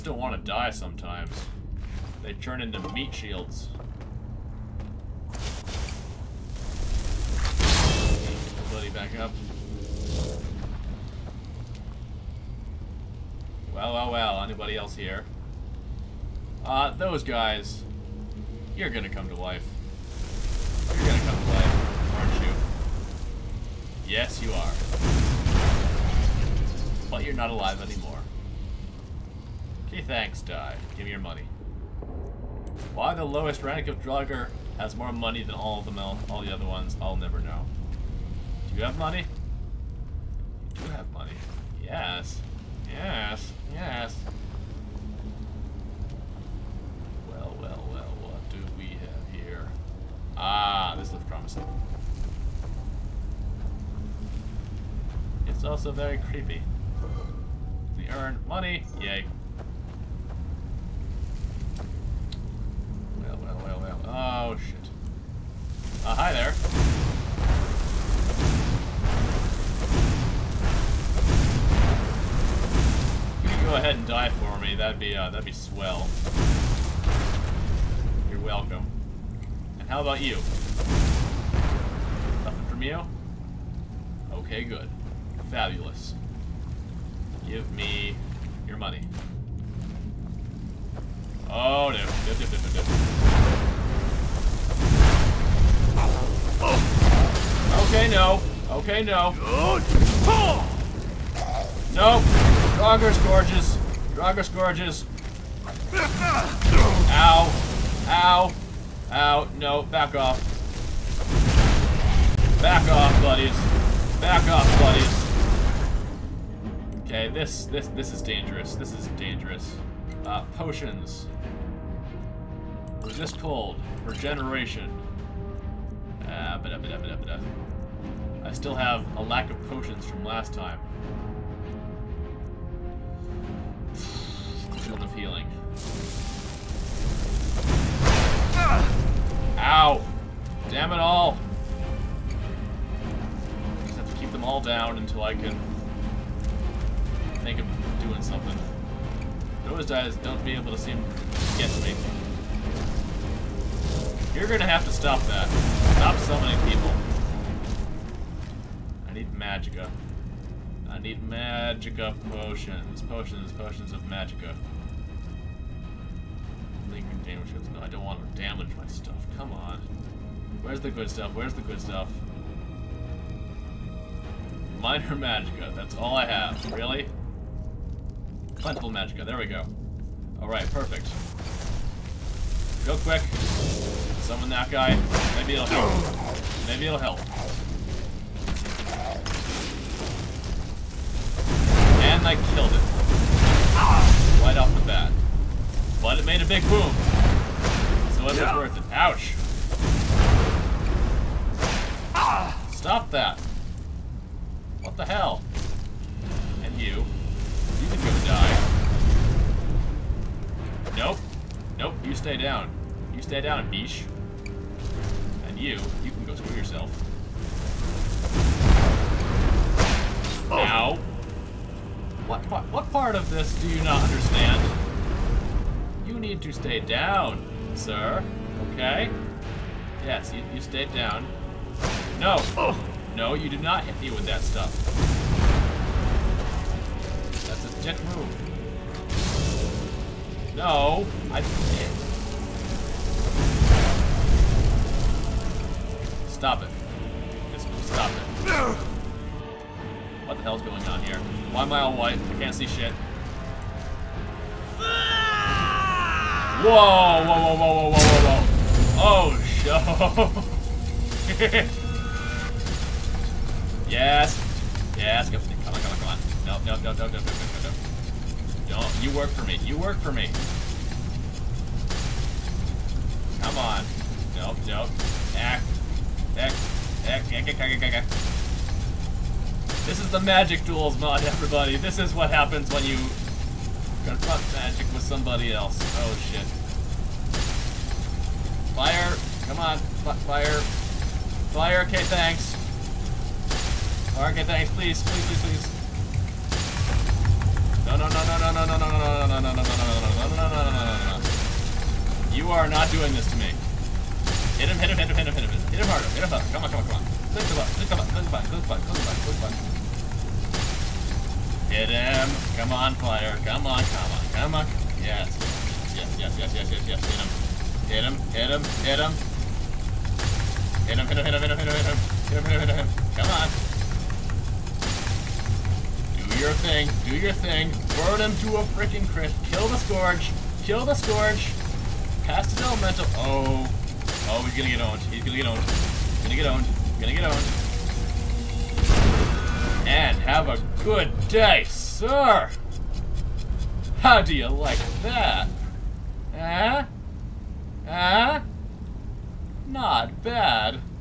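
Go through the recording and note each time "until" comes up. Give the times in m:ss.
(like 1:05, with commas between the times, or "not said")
2:24.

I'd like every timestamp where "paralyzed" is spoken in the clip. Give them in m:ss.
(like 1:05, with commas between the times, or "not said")
not said.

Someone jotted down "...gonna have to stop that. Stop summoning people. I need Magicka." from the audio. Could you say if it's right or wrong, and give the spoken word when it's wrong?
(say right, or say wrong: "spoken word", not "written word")
right.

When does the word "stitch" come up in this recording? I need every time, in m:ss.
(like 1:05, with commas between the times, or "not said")
not said.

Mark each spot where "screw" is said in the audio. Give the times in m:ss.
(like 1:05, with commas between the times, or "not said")
3:36.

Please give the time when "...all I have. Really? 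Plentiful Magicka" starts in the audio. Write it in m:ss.
2:55.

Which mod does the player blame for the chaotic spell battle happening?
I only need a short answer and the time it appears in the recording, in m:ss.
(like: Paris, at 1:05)
magic duels mod, at 4:40.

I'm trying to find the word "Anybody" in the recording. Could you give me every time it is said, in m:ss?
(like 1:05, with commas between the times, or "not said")
0:14.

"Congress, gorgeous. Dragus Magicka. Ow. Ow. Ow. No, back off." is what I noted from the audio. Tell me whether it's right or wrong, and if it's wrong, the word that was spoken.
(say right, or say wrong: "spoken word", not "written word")
wrong: "Gorges", not "Magicka".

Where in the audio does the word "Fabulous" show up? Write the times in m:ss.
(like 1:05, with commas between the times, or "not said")
1:25.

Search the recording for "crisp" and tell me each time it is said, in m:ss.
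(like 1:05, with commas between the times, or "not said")
5:29.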